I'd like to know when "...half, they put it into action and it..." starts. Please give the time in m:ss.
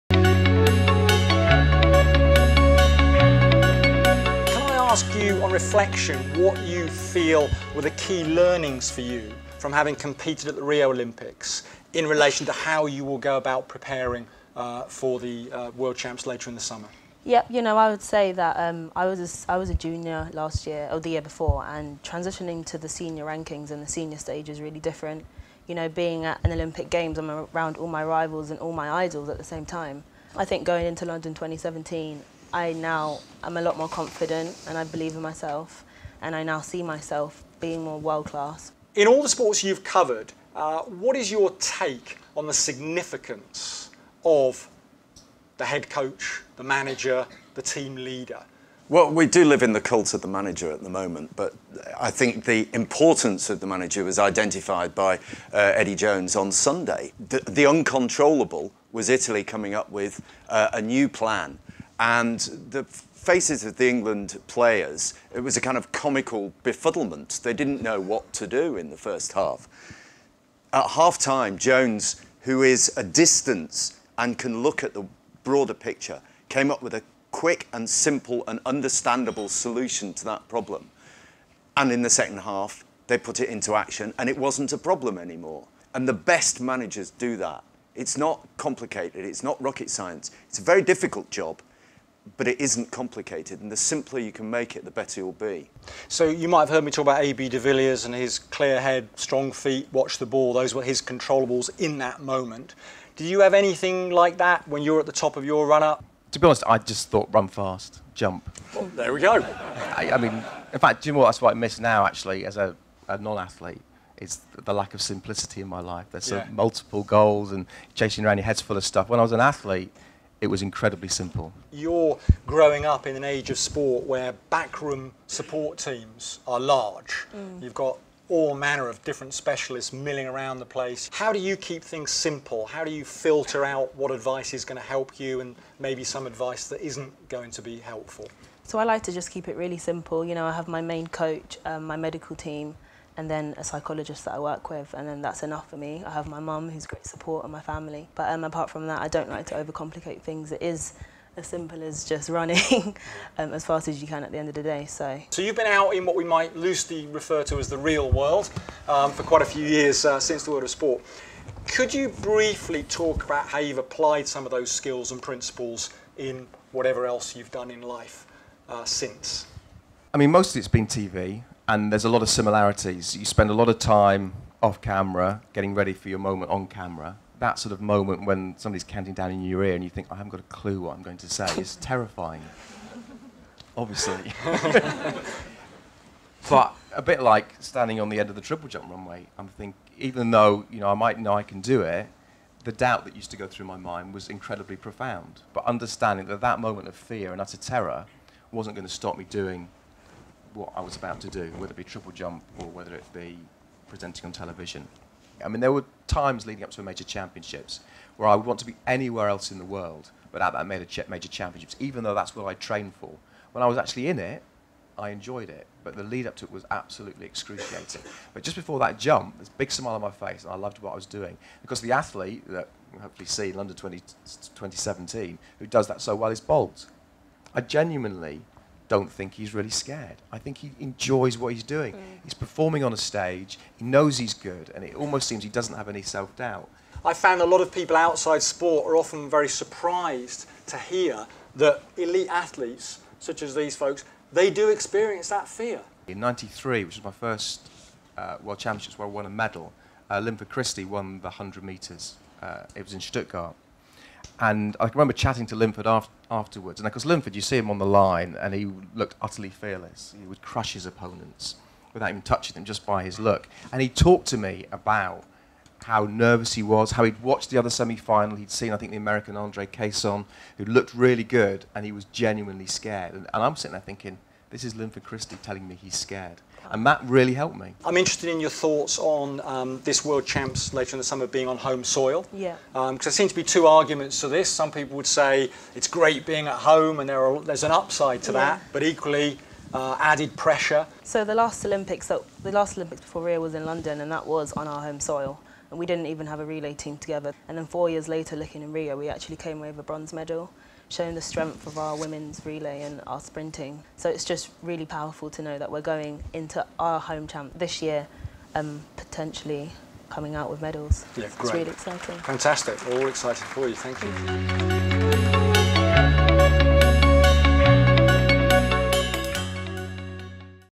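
1:22.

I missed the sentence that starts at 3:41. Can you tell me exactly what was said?
Because the athlete that we'll hopefully see in London 20, 2017, who does that so well, is Bolt.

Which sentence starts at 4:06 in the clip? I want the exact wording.
In 93, which was my first uh, World Championships where I won a medal, uh, Linford Christie won the 100 metres.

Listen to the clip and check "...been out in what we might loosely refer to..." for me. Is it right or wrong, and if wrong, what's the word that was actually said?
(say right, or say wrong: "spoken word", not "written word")
right.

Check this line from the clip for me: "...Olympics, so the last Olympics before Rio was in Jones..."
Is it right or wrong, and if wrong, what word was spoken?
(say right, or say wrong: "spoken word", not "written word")
wrong: "London", not "Jones".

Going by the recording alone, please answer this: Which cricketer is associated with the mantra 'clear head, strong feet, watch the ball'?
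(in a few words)
A.B. de Villiers.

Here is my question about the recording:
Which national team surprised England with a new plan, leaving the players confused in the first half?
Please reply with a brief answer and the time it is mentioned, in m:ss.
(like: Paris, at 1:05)
Italy, at 0:59.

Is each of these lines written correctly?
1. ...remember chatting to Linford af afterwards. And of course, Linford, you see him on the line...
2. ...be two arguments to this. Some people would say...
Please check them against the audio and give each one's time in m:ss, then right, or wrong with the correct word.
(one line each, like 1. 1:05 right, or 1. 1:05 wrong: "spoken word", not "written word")
1. 4:14 right
2. 4:43 right.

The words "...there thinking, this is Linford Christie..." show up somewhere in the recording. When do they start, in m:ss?
4:33.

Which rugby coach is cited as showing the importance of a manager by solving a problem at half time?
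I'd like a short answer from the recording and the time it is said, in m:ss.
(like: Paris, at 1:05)
Eddie Jones, at 0:55.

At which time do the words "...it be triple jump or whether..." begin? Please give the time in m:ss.
3:21.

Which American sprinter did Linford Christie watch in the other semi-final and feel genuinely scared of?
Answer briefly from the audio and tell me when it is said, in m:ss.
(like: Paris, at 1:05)
Andre Cason, at 4:29.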